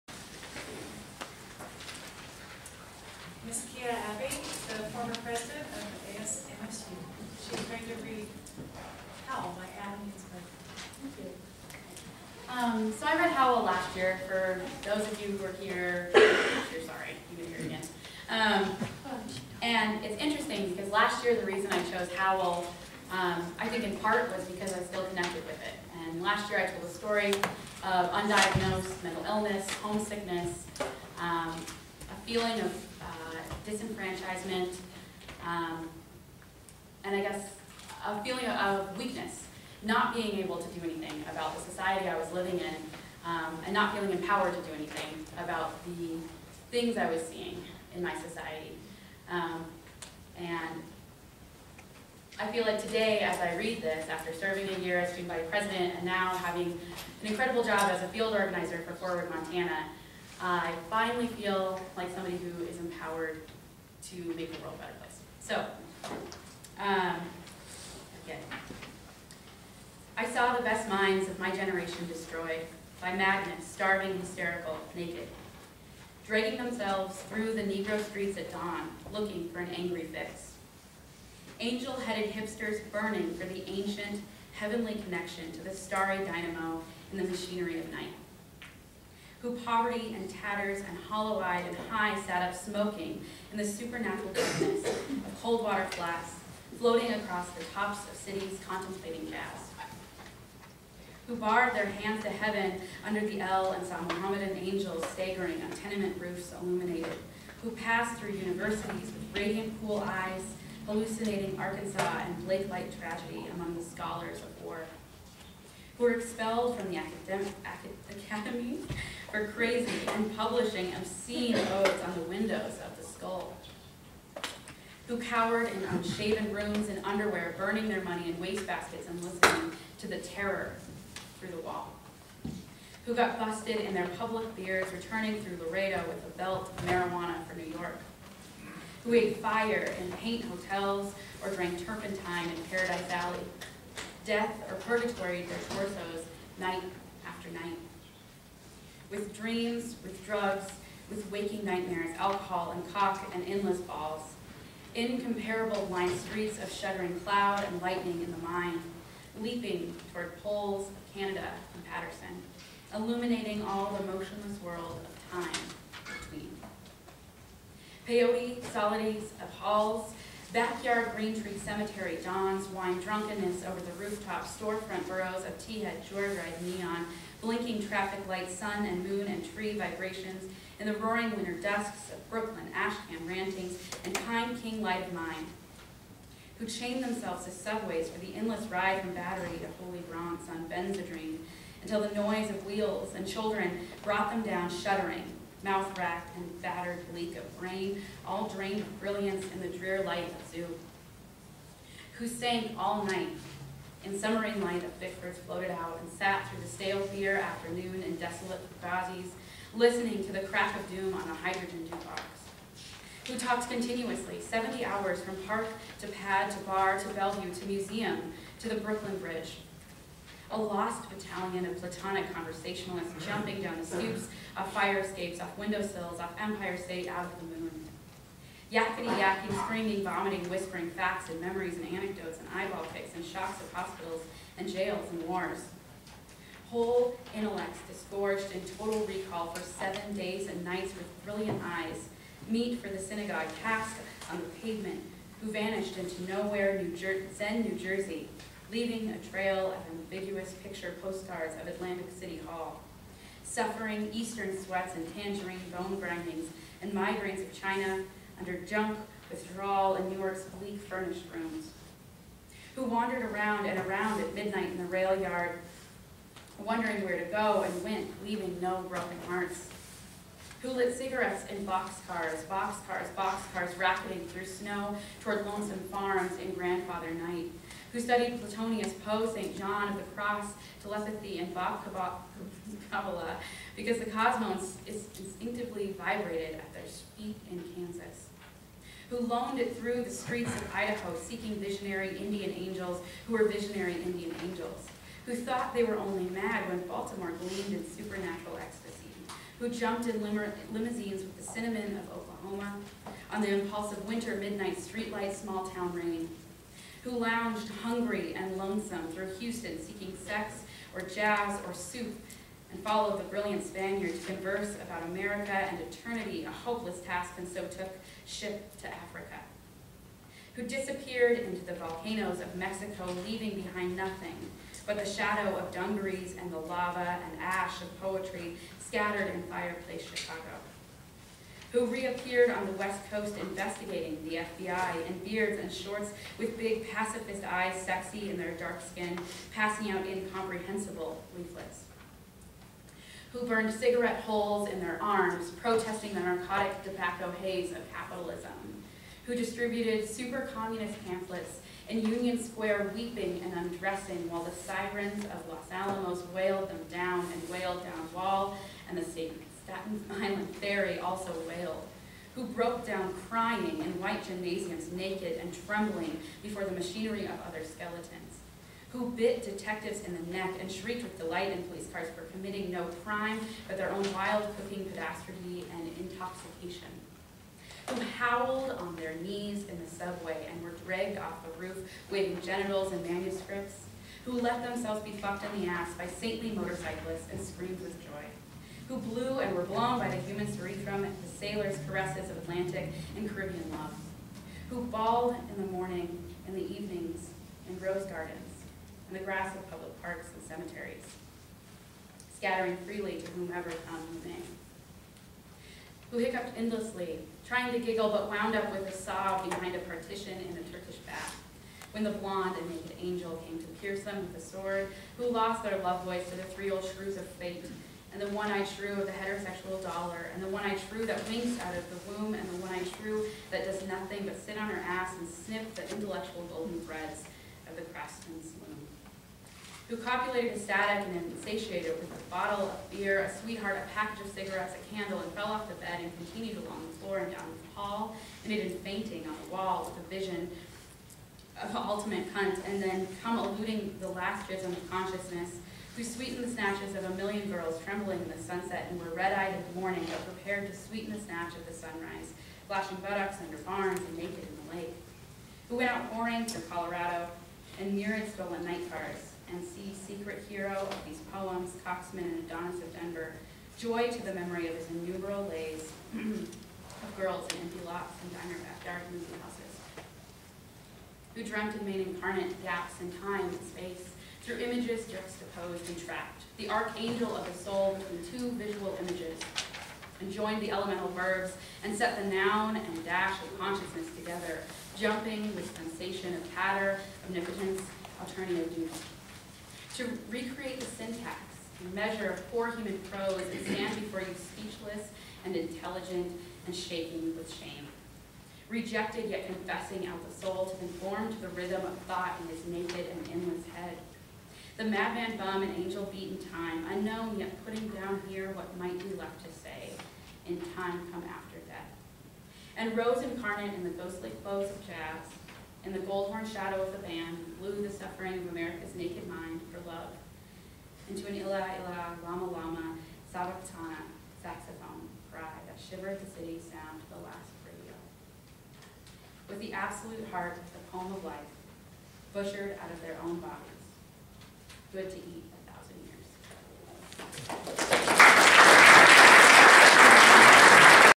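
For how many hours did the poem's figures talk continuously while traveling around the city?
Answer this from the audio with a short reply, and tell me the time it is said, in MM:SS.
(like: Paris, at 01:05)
70, at 03:34.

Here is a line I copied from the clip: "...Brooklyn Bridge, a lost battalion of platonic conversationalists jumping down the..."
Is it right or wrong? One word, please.
right.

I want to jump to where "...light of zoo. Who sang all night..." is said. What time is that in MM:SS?
03:20.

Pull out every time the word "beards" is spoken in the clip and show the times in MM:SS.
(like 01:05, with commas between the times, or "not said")
02:14, 05:35.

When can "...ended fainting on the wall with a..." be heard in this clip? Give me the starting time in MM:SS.
07:18.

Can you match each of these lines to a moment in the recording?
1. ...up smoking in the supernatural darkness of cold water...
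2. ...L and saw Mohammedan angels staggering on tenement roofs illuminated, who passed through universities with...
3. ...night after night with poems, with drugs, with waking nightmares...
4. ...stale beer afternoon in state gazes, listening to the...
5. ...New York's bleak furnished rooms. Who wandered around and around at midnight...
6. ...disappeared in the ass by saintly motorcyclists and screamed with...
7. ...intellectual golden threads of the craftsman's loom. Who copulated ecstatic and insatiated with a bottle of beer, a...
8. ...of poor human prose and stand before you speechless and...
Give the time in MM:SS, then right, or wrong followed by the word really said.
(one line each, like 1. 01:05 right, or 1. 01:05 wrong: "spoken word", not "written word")
1. 01:32 right
2. 01:43 right
3. 02:26 wrong: "dreams", not "poems"
4. 03:26 wrong: "desolate", not "state"
5. 04:20 right
6. 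06:25 wrong: "fucked", not "disappeared"
7. 07:05 right
8. 08:12 right.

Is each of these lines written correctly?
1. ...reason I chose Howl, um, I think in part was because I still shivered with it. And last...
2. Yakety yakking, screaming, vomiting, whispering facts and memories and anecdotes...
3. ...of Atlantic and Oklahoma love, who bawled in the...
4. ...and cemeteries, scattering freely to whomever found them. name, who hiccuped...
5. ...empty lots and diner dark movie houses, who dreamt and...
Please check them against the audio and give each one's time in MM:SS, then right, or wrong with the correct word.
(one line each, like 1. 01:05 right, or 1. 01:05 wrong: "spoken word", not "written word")
1. 00:21 wrong: "connected", not "shivered"
2. 03:48 right
3. 06:32 wrong: "Caribbean", not "Oklahoma"
4. 06:40 right
5. 07:47 right.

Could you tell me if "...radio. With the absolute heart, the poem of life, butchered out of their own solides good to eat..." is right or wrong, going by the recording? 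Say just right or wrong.
wrong.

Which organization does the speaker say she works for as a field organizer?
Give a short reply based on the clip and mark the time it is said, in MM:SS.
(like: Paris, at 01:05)
Forward Montana, at 00:58.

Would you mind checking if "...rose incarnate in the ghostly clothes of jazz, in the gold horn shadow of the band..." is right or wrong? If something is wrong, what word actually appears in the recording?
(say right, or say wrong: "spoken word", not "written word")
right.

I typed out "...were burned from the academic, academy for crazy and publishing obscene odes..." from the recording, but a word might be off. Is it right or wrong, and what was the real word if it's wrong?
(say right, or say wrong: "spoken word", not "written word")
wrong: "expelled", not "burned".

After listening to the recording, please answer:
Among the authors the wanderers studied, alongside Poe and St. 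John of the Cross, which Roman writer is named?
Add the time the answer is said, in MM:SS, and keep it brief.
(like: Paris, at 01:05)
Suetonius, at 04:38.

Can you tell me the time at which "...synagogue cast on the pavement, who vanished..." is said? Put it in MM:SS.
04:02.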